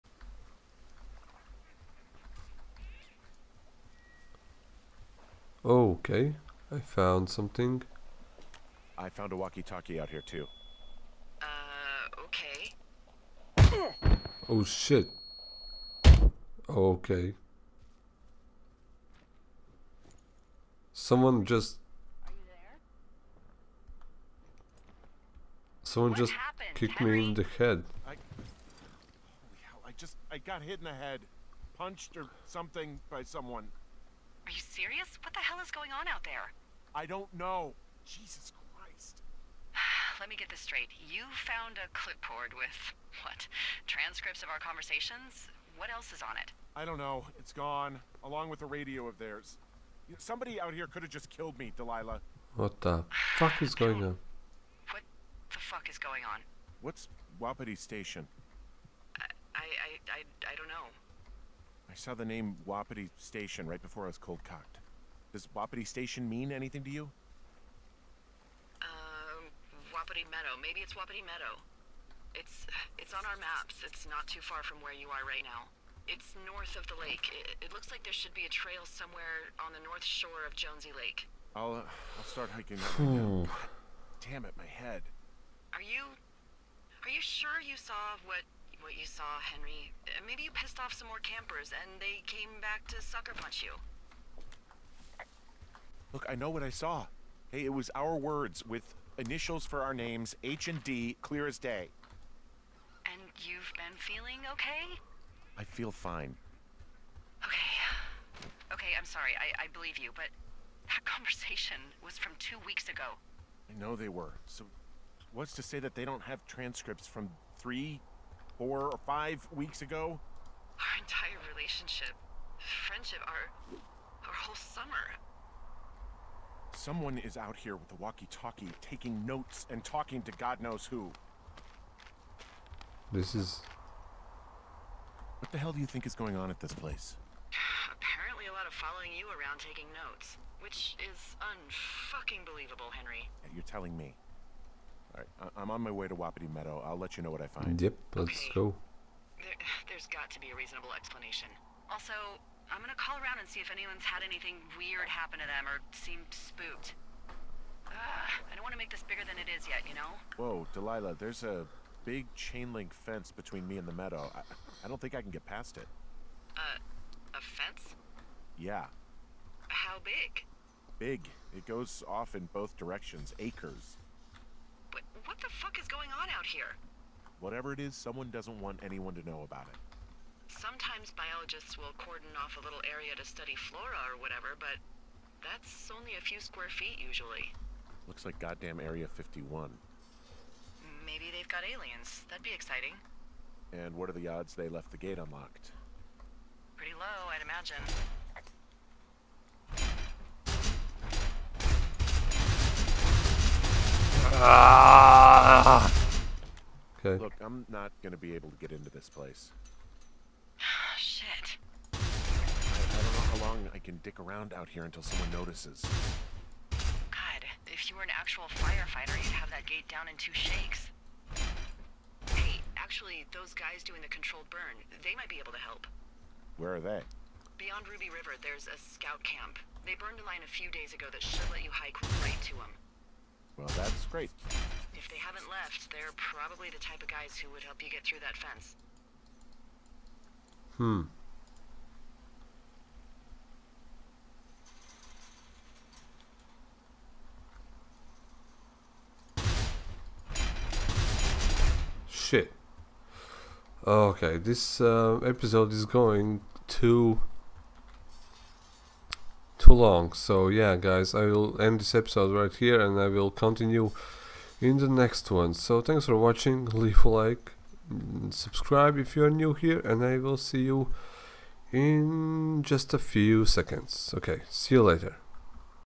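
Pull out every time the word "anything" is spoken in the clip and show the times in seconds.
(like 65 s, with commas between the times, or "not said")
66 s, 154 s.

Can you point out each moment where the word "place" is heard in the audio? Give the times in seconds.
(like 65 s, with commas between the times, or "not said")
136 s, 209 s.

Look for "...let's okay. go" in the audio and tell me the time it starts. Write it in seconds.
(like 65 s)
148 s.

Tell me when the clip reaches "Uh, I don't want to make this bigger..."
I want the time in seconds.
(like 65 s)
157 s.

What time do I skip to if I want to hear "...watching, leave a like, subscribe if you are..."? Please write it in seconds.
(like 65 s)
266 s.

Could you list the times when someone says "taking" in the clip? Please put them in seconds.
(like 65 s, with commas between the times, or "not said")
128 s, 139 s.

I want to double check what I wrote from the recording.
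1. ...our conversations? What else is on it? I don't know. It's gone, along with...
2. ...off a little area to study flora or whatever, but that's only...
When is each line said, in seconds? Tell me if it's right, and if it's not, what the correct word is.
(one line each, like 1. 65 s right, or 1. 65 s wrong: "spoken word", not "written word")
1. 44 s right
2. 182 s right.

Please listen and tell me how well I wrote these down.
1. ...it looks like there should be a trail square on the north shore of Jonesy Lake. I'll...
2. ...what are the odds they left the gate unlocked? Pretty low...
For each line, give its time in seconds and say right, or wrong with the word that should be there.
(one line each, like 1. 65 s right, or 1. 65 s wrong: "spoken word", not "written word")
1. 77 s wrong: "somewhere", not "square"
2. 193 s right.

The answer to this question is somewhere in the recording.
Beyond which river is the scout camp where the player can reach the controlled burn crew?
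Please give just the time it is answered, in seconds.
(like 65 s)
227 s.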